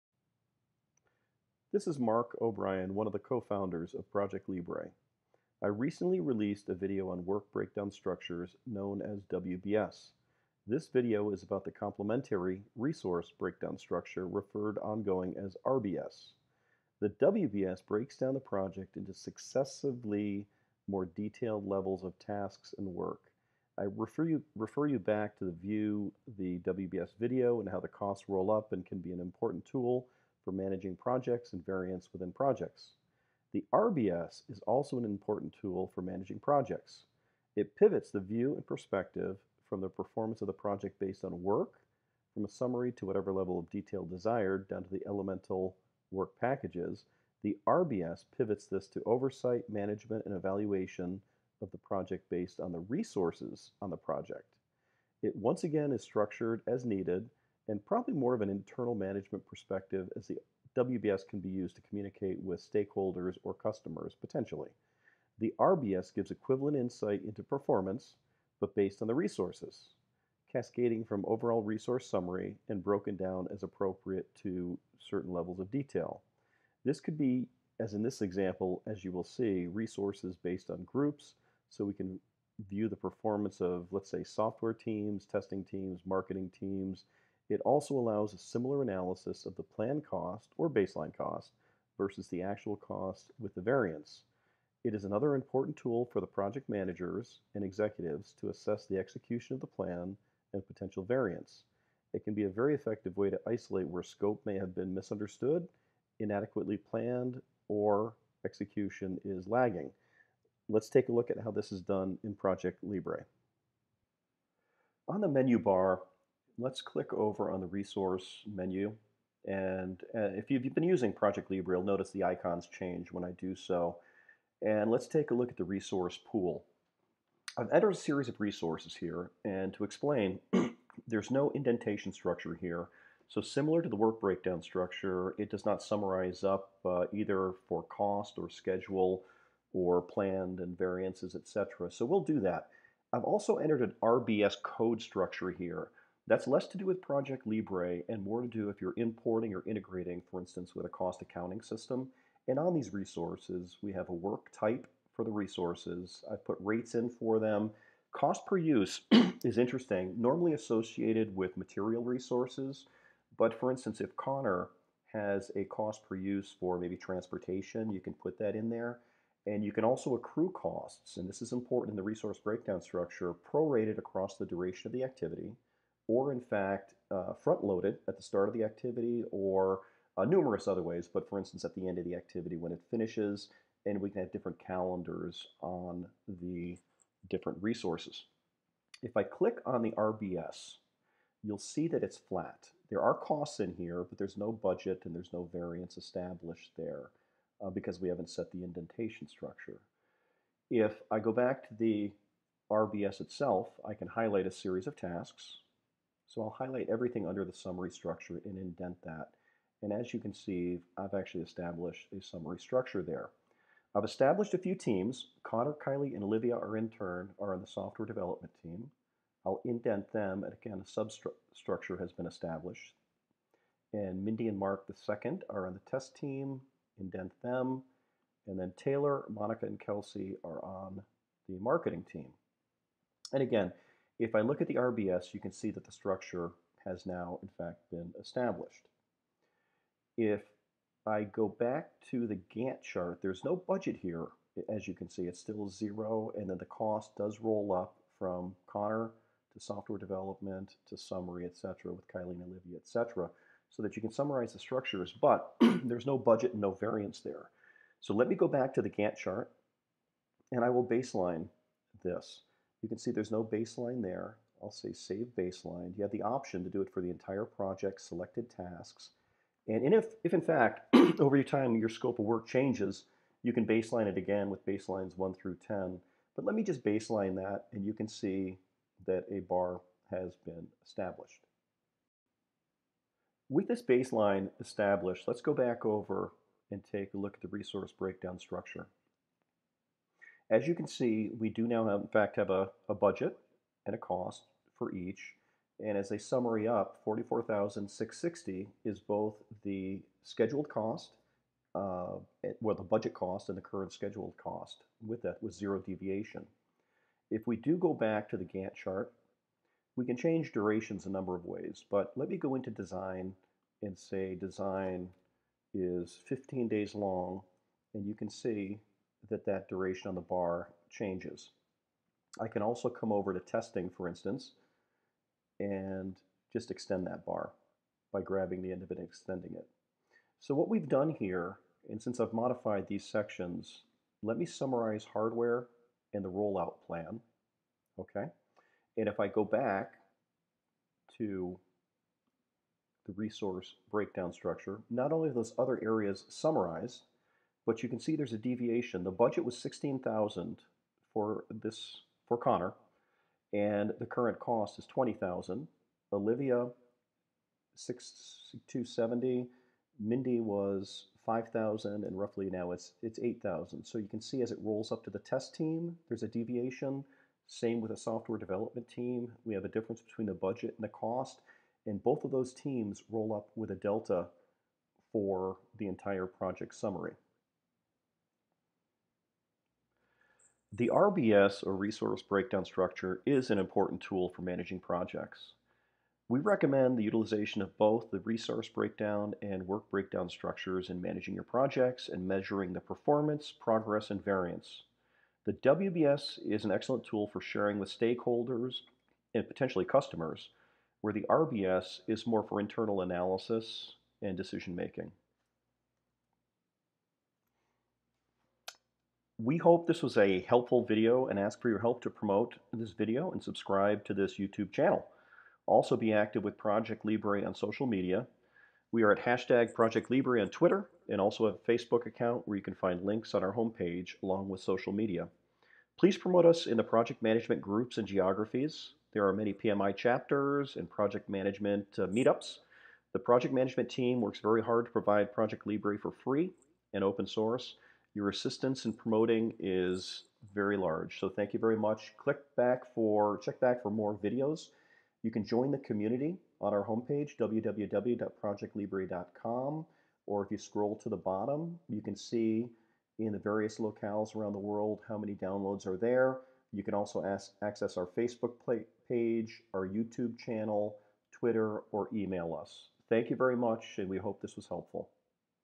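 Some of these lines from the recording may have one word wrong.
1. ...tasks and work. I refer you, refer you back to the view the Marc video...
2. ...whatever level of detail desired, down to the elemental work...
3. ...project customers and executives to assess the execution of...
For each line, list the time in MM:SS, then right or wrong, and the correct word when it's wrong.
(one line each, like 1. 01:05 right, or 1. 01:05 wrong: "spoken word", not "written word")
1. 00:22 wrong: "WBS", not "Marc"
2. 00:43 right
3. 01:36 wrong: "managers", not "customers".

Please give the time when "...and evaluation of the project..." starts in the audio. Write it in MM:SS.
00:50.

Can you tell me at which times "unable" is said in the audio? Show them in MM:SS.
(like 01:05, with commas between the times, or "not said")
not said.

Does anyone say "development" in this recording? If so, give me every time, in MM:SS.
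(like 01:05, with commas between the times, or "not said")
03:38, 04:09, 06:08.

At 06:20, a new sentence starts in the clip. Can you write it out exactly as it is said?
The RBS, or Resource Breakdown Structure, is an important tool for managing projects.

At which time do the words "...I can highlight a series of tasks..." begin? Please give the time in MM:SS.
03:23.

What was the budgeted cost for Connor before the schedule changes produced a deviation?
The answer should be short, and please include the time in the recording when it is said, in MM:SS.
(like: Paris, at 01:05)
16,000, at 05:49.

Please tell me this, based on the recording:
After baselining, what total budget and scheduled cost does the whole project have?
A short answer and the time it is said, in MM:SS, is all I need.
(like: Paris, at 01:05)
44660, at 04:57.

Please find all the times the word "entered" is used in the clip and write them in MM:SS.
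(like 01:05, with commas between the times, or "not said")
02:07, 02:23.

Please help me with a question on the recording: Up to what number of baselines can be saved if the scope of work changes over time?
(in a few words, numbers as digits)
10.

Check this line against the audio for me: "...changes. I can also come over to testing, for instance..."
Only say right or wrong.
right.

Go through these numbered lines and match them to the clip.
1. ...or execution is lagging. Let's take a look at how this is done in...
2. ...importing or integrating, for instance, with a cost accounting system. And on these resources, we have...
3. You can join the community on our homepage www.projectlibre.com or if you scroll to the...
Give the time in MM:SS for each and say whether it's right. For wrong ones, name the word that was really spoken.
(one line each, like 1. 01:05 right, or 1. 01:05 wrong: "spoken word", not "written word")
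1. 01:47 right
2. 02:28 right
3. 07:25 right.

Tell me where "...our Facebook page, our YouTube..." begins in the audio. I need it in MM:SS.
07:37.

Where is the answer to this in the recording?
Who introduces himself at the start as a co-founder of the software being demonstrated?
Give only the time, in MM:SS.
00:02.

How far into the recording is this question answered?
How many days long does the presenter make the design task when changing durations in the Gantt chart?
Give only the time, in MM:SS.
05:16.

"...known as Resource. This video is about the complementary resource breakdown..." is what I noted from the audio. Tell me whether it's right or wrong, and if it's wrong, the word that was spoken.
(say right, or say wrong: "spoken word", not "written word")
wrong: "WBS", not "Resource".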